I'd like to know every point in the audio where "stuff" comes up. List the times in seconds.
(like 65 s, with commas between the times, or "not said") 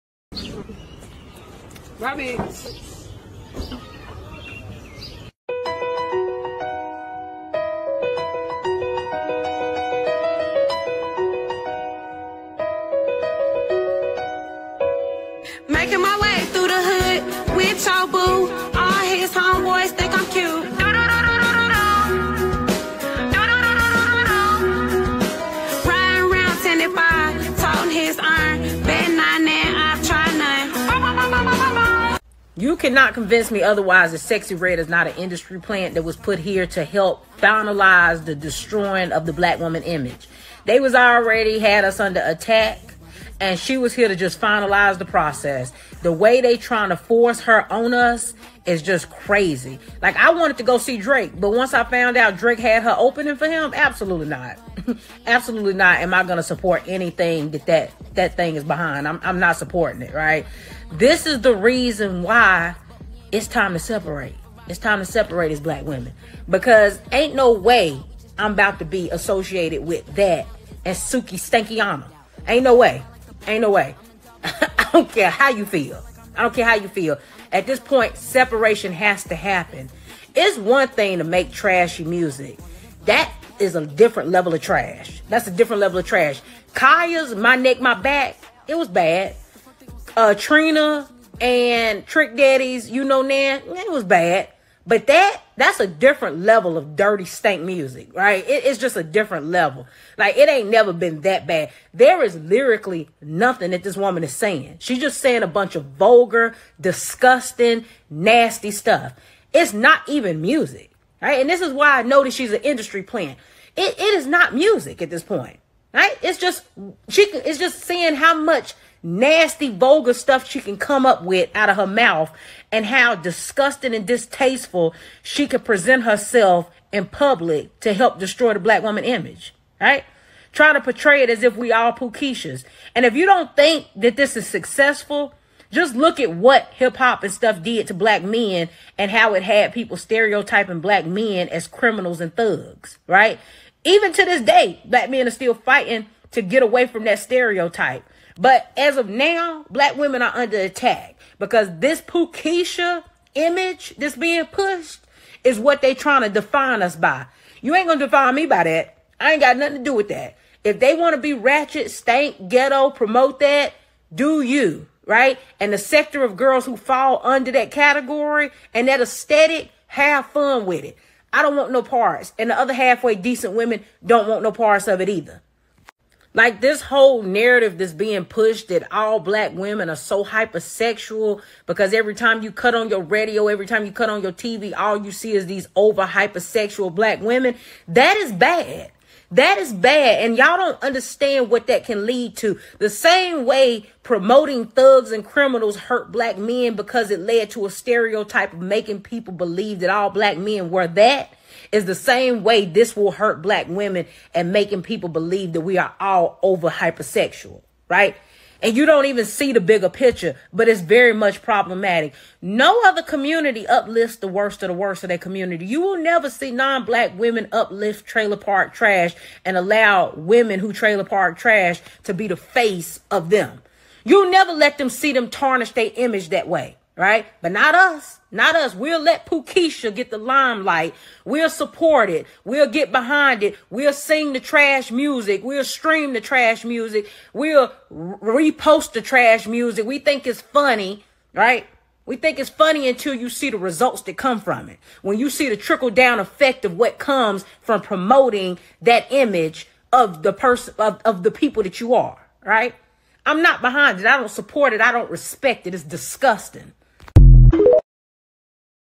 108 s, 120 s, 137 s.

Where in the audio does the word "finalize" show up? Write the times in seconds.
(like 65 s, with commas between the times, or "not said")
37 s, 44 s.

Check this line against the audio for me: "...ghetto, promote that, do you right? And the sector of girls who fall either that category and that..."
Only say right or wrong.
wrong.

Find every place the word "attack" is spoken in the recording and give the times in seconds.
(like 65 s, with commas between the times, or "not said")
42 s, 150 s.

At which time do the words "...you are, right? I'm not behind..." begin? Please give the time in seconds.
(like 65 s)
251 s.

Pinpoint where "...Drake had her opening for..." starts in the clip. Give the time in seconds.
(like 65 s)
52 s.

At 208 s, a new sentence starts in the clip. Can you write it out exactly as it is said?
and you don't even see the bigger picture, but it's very much problematic.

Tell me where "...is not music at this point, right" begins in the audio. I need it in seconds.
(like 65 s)
114 s.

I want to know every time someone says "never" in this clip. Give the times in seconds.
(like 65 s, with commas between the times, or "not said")
100 s, 215 s, 224 s.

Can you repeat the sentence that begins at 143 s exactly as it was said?
Even to this day, black men are still fighting to get away from that stereotype.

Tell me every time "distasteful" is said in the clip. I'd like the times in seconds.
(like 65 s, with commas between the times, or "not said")
124 s.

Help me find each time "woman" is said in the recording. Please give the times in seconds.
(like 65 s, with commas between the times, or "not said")
39 s, 103 s, 128 s.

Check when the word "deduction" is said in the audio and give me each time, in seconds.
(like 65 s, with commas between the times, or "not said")
not said.